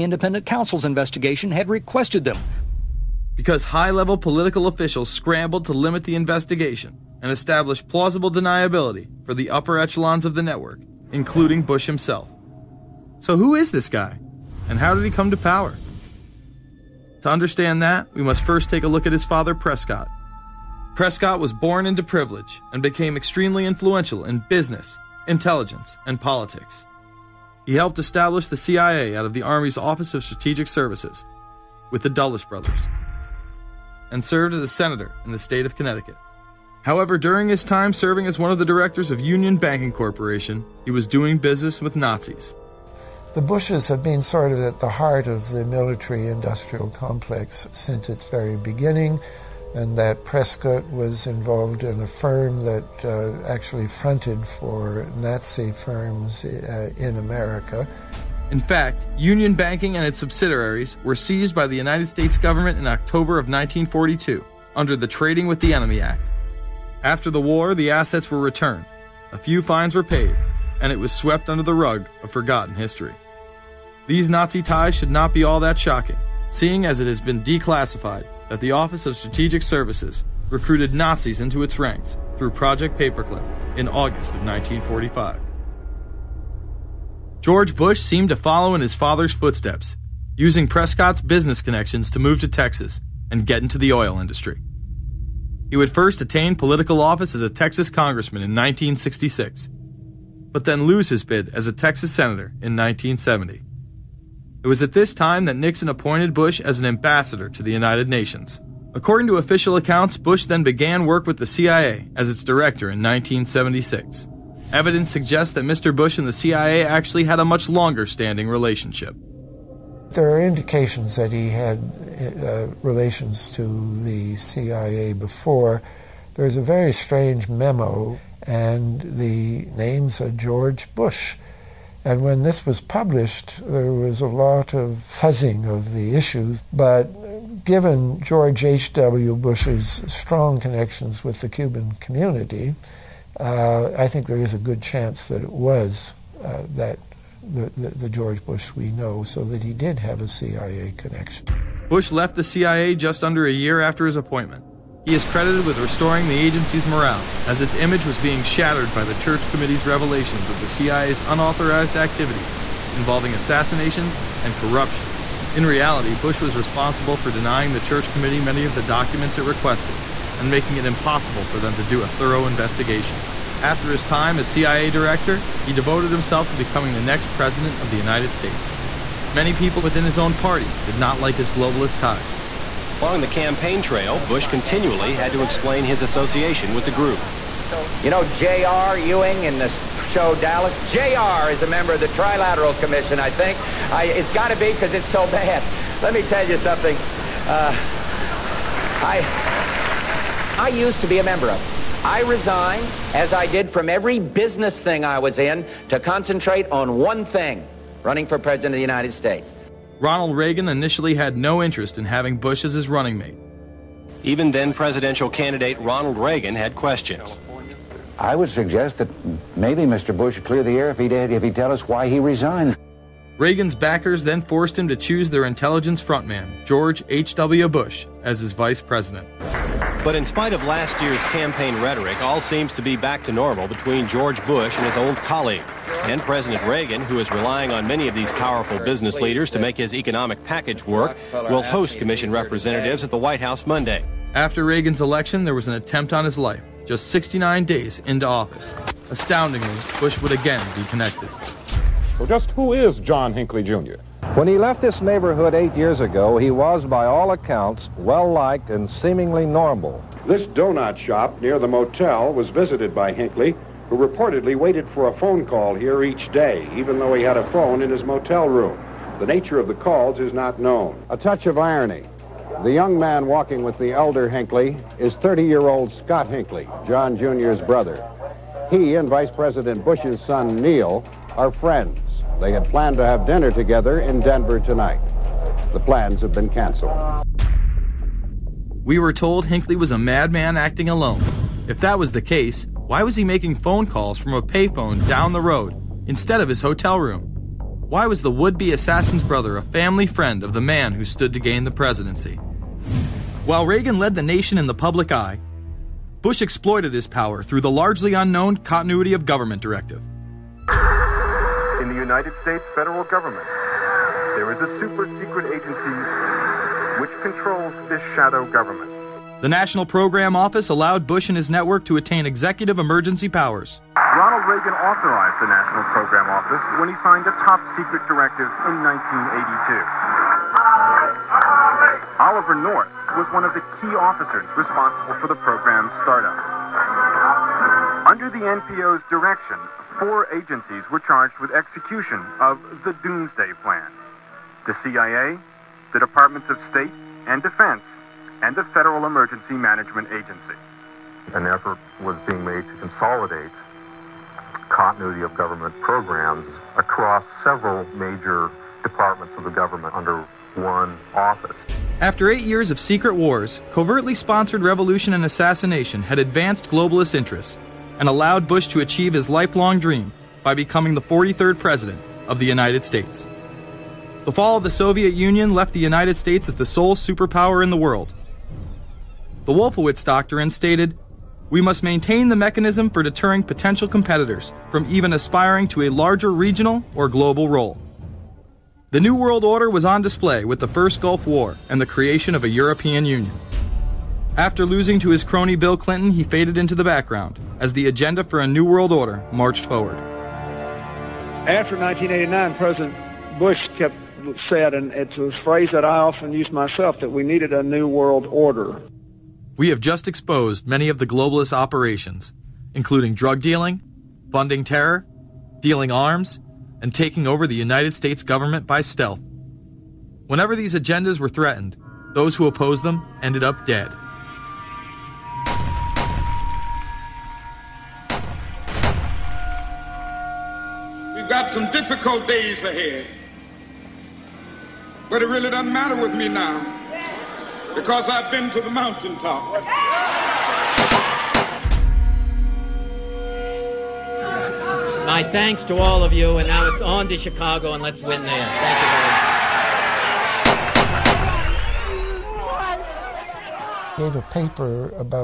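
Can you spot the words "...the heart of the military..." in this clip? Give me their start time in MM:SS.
00:44.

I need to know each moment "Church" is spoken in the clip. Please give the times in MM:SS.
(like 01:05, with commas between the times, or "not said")
02:39, 02:47.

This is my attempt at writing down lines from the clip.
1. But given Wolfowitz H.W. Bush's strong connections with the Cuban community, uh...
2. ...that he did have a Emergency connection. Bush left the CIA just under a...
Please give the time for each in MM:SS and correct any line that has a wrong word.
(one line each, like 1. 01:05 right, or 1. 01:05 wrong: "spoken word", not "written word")
1. 02:16 wrong: "George", not "Wolfowitz"
2. 02:29 wrong: "CIA", not "Emergency".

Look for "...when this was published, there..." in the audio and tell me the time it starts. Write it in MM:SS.
02:12.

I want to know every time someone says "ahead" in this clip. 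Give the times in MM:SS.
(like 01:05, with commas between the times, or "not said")
07:12.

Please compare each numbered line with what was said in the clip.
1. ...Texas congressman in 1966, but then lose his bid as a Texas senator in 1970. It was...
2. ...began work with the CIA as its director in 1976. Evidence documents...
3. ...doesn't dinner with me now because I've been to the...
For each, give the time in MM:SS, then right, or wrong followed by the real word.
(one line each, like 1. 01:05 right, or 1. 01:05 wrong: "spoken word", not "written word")
1. 01:37 right
2. 01:50 wrong: "suggests", not "documents"
3. 07:15 wrong: "matter", not "dinner".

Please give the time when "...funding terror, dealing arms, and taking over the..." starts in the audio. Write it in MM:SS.
06:54.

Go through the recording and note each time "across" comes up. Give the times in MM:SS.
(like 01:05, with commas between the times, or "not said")
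05:56.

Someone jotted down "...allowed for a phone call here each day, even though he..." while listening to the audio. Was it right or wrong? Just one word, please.
wrong.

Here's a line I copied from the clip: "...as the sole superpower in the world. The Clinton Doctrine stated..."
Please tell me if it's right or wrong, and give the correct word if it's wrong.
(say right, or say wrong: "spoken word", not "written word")
wrong: "Wolfowitz", not "Clinton".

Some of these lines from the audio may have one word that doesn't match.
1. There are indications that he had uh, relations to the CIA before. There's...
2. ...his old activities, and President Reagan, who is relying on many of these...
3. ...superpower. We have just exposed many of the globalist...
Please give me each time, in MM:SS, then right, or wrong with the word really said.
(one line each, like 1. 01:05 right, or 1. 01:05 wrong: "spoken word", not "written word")
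1. 02:00 right
2. 03:54 wrong: "colleagues", not "activities"
3. 06:48 wrong: "order", not "superpower".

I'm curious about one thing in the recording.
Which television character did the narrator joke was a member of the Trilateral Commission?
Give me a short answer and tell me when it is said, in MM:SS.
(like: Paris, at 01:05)
J.R. Ewing, at 03:08.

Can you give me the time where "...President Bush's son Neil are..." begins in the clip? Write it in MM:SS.
04:39.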